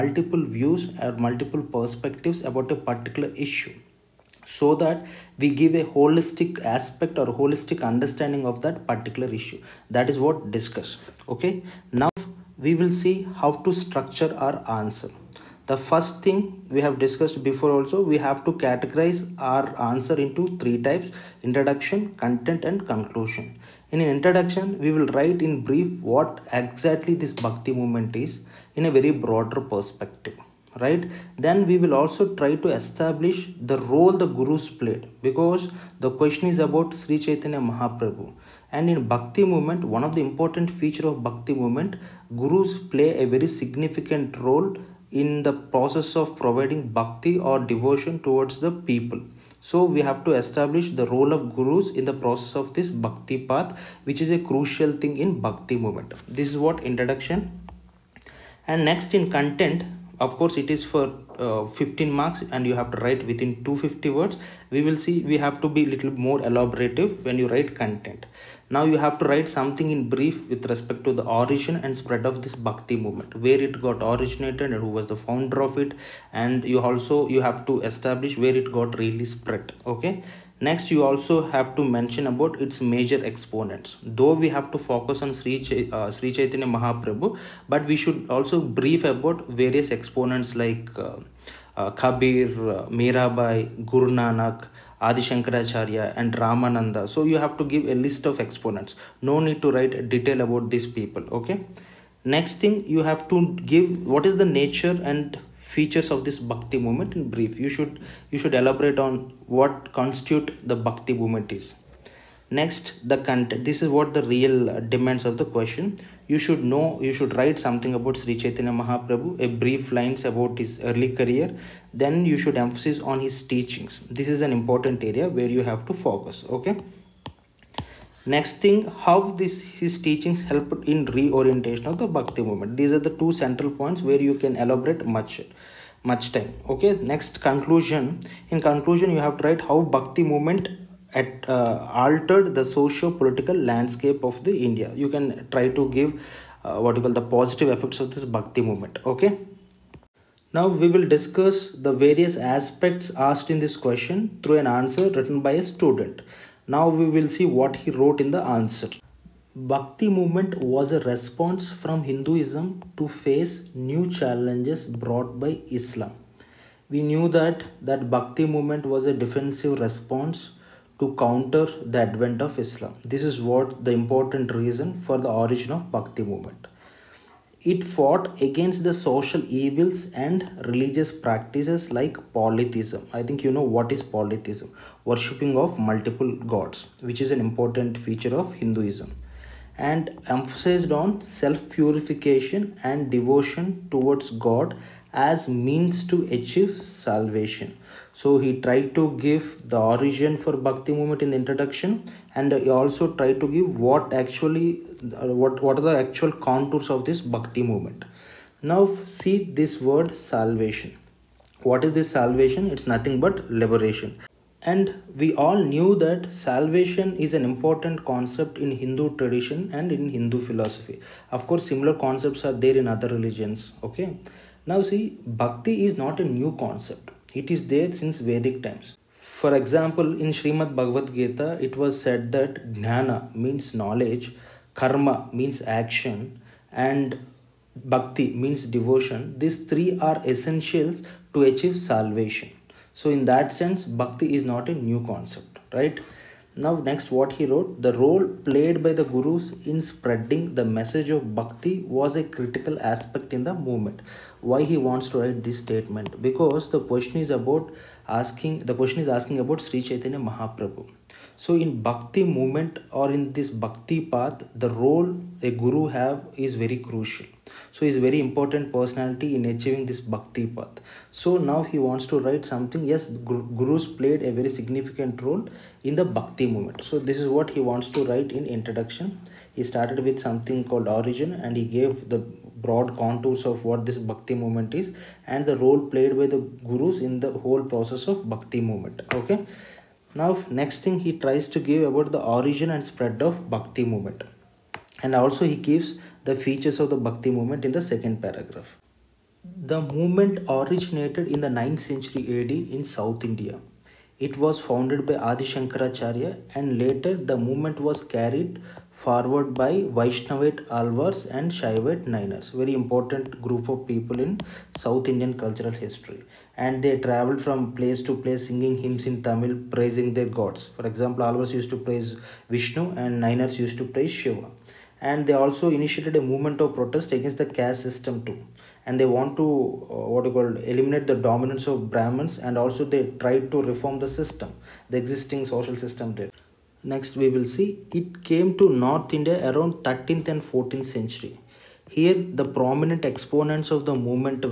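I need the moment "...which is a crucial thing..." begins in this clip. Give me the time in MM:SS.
00:54.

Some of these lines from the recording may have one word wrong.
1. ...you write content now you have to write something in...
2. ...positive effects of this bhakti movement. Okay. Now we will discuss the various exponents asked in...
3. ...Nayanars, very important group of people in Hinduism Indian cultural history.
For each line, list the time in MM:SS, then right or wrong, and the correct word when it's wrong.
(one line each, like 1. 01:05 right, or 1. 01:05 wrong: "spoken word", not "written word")
1. 01:07 right
2. 02:27 wrong: "aspects", not "exponents"
3. 05:12 wrong: "South", not "Hinduism".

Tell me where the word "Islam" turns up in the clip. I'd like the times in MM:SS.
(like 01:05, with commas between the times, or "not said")
02:45, 02:52.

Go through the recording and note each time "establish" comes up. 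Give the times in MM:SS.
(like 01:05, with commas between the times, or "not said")
00:32, 00:50, 01:17.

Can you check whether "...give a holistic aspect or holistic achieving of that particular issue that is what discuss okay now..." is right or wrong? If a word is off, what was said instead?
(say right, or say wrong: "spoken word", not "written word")
wrong: "understanding", not "achieving".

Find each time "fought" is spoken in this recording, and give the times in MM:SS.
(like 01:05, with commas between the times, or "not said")
02:57.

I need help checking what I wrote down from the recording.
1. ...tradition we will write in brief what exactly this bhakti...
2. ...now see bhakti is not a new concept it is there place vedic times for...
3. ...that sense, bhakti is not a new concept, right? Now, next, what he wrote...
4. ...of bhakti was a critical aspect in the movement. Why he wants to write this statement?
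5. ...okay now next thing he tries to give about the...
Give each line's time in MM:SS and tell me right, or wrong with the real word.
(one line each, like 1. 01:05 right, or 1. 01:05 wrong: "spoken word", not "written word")
1. 00:24 wrong: "introduction", not "tradition"
2. 03:44 wrong: "since", not "place"
3. 04:03 right
4. 04:11 right
5. 04:49 right.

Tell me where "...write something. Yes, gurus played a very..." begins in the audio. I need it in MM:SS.
04:32.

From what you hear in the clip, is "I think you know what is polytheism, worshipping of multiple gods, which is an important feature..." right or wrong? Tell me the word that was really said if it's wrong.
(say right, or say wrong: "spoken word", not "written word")
right.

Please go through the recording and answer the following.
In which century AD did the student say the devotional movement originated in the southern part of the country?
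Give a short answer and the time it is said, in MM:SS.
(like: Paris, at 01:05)
9th century, at 05:01.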